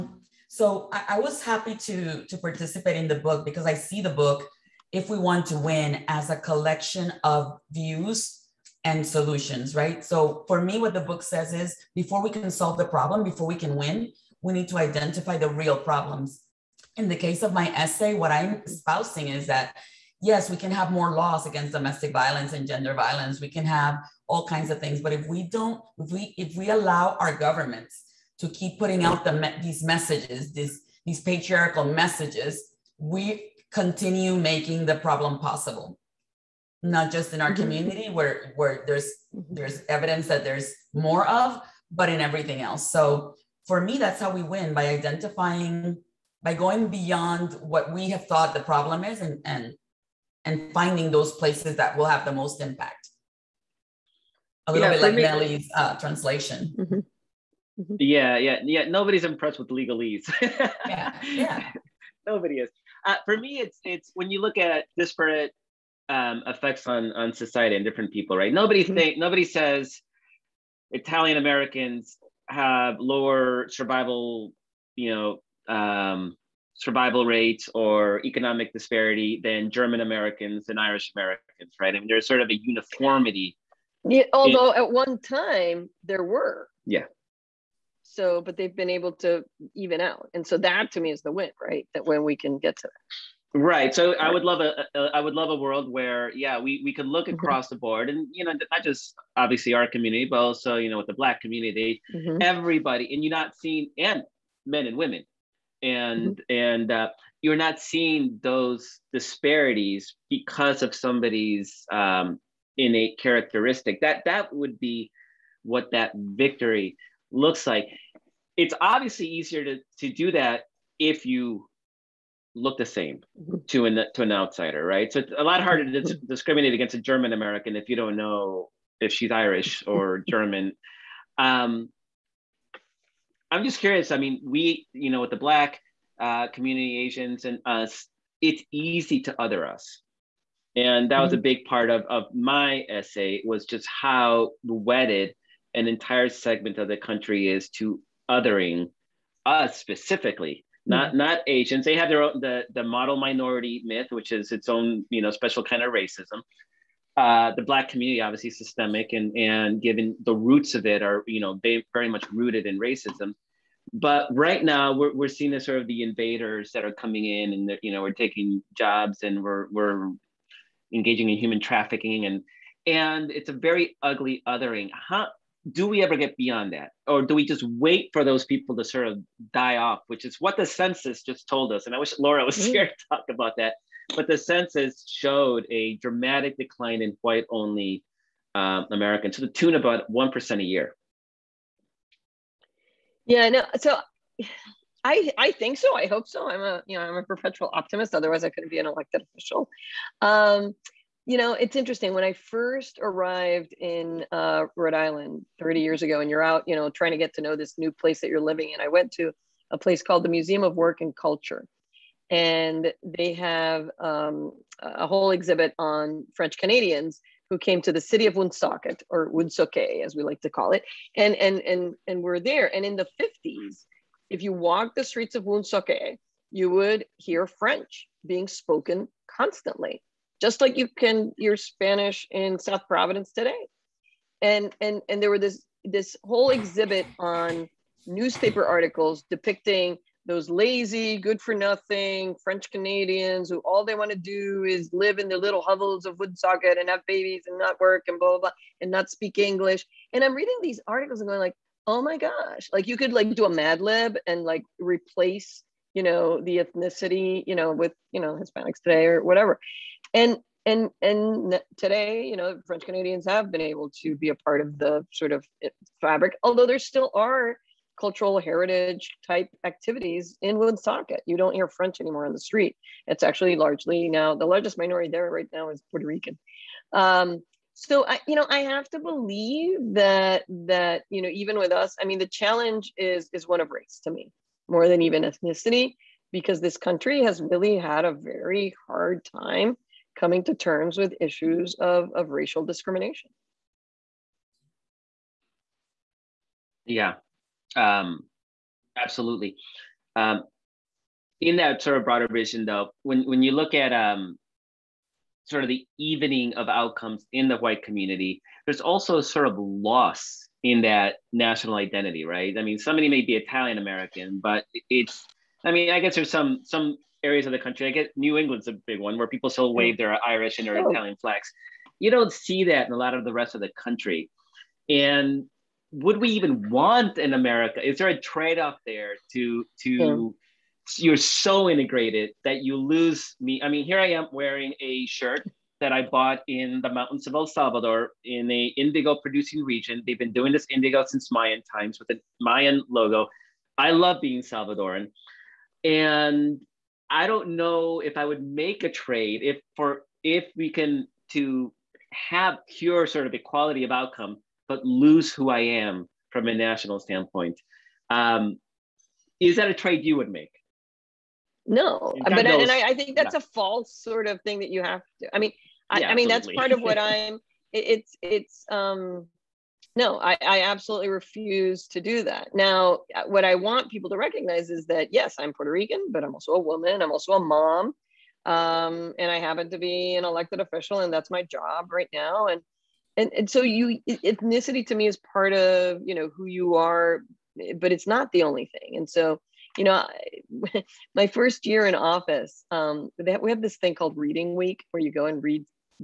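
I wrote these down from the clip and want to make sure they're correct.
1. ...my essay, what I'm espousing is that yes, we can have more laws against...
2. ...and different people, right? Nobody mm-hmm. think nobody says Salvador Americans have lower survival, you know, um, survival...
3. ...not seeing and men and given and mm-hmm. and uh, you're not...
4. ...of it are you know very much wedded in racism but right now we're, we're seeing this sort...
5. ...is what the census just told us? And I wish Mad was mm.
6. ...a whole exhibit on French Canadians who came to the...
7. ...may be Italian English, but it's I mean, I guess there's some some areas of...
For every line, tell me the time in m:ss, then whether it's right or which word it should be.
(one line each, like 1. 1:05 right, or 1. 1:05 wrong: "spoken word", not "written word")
1. 0:17 right
2. 1:07 wrong: "Italian", not "Salvador"
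3. 1:43 wrong: "women", not "given"
4. 2:40 wrong: "rooted", not "wedded"
5. 3:00 wrong: "Laura", not "Mad"
6. 3:34 right
7. 5:13 wrong: "American", not "English".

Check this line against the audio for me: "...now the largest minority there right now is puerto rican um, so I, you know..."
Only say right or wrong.
right.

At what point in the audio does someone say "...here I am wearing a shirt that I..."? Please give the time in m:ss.
5:33.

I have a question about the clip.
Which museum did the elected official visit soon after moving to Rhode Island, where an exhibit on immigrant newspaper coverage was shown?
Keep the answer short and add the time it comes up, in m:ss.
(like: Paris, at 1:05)
Museum of Work and Culture, at 3:30.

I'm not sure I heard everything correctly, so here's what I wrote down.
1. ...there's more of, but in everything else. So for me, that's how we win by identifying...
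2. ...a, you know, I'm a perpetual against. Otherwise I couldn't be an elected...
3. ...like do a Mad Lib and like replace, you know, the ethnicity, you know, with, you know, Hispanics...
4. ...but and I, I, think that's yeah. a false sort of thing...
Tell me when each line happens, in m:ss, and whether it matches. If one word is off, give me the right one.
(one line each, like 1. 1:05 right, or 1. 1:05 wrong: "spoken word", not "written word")
1. 0:40 right
2. 3:16 wrong: "optimist", not "against"
3. 4:13 right
4. 6:02 right.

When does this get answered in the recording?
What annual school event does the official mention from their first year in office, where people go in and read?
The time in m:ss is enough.
6:34.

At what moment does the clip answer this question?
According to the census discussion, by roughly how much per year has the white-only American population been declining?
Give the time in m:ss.
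3:09.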